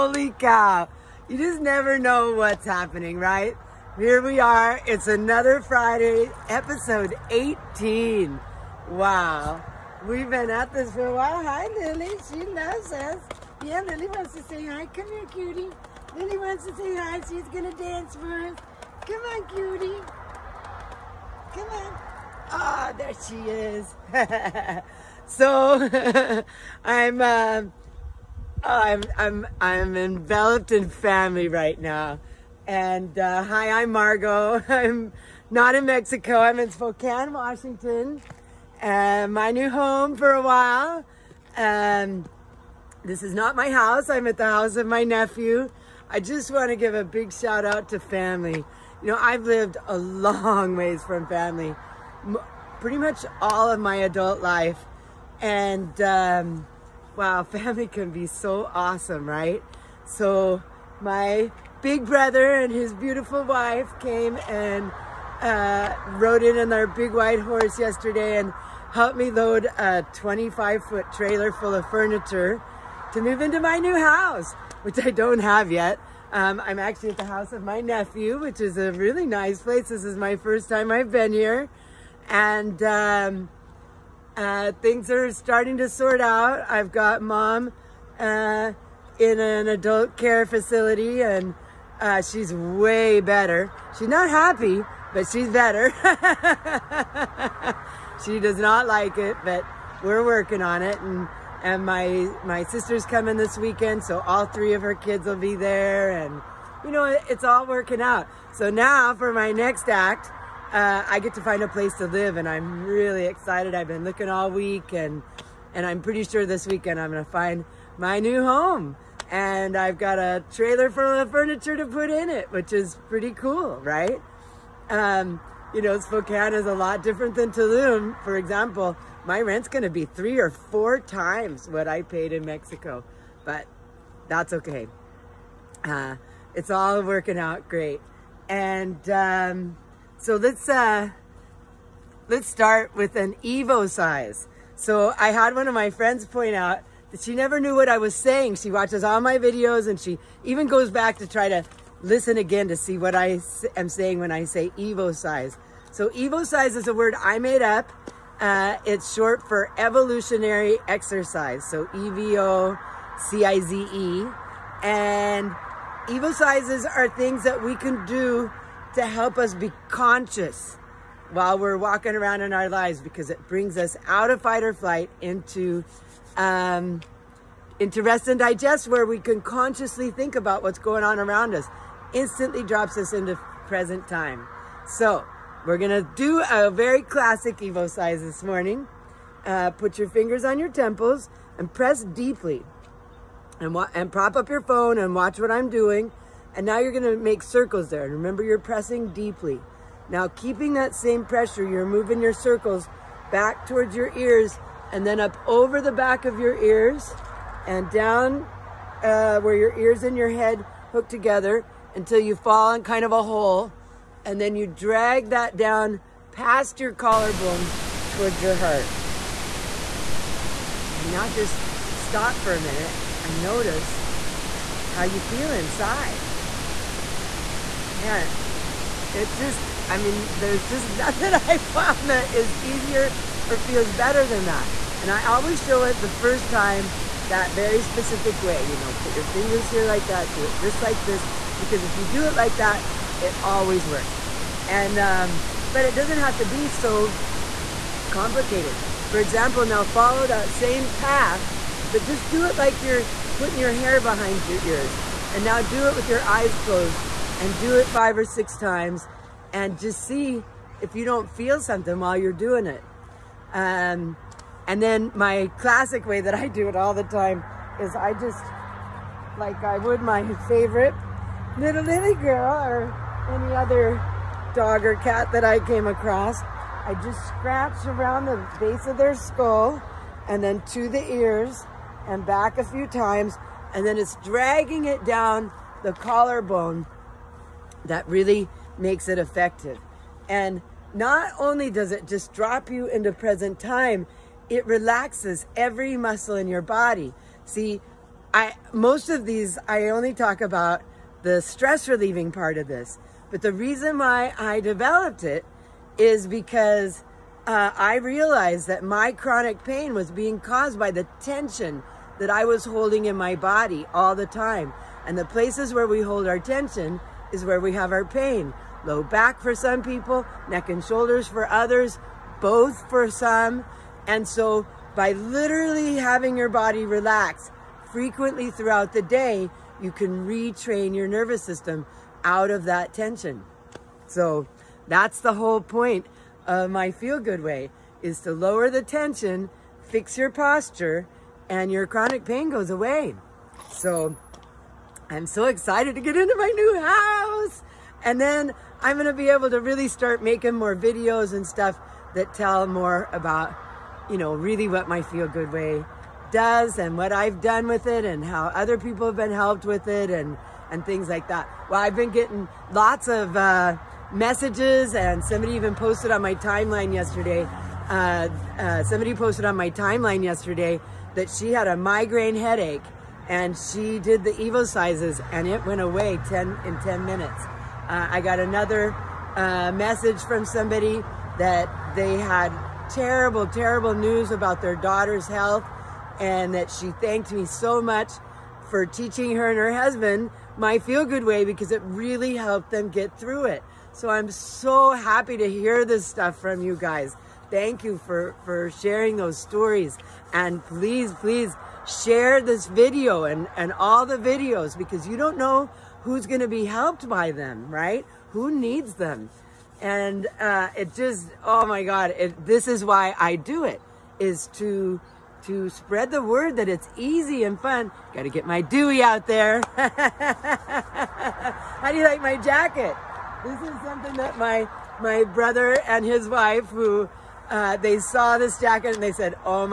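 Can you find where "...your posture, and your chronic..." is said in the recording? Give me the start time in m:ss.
5:40.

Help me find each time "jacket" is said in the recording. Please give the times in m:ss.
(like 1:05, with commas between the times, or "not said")
7:02, 7:08.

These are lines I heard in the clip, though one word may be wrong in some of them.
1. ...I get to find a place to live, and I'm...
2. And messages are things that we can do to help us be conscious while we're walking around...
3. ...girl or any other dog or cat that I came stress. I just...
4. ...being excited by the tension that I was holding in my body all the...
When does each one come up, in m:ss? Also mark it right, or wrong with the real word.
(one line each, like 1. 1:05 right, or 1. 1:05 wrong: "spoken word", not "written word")
1. 1:51 right
2. 2:44 wrong: "evocizes", not "messages"
3. 4:32 wrong: "across", not "stress"
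4. 5:10 wrong: "caused", not "excited".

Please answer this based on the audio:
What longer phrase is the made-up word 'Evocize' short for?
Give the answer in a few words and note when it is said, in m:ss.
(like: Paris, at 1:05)
evolutionary exercise, at 2:39.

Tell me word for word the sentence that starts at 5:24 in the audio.
And so by literally having your body relax frequently throughout the day, you can retrain your nervous system out of that tension.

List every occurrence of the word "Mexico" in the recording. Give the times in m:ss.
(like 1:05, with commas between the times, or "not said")
0:35, 2:12.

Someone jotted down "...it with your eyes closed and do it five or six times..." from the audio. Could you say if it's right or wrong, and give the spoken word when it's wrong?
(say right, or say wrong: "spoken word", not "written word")
right.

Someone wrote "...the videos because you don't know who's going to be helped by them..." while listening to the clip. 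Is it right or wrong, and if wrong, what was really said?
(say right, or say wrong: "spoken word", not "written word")
right.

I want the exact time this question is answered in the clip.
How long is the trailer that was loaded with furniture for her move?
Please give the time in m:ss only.
1:10.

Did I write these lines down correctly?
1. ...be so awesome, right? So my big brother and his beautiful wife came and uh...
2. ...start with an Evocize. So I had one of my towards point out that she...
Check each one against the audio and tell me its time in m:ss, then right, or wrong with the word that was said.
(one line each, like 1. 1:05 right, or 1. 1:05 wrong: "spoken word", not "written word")
1. 0:58 right
2. 2:22 wrong: "friends", not "towards".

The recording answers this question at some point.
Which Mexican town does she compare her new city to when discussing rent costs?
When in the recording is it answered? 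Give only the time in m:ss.
2:07.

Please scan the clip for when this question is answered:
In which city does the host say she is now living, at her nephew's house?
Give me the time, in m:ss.
0:36.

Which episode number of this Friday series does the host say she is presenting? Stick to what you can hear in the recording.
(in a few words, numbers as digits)
18.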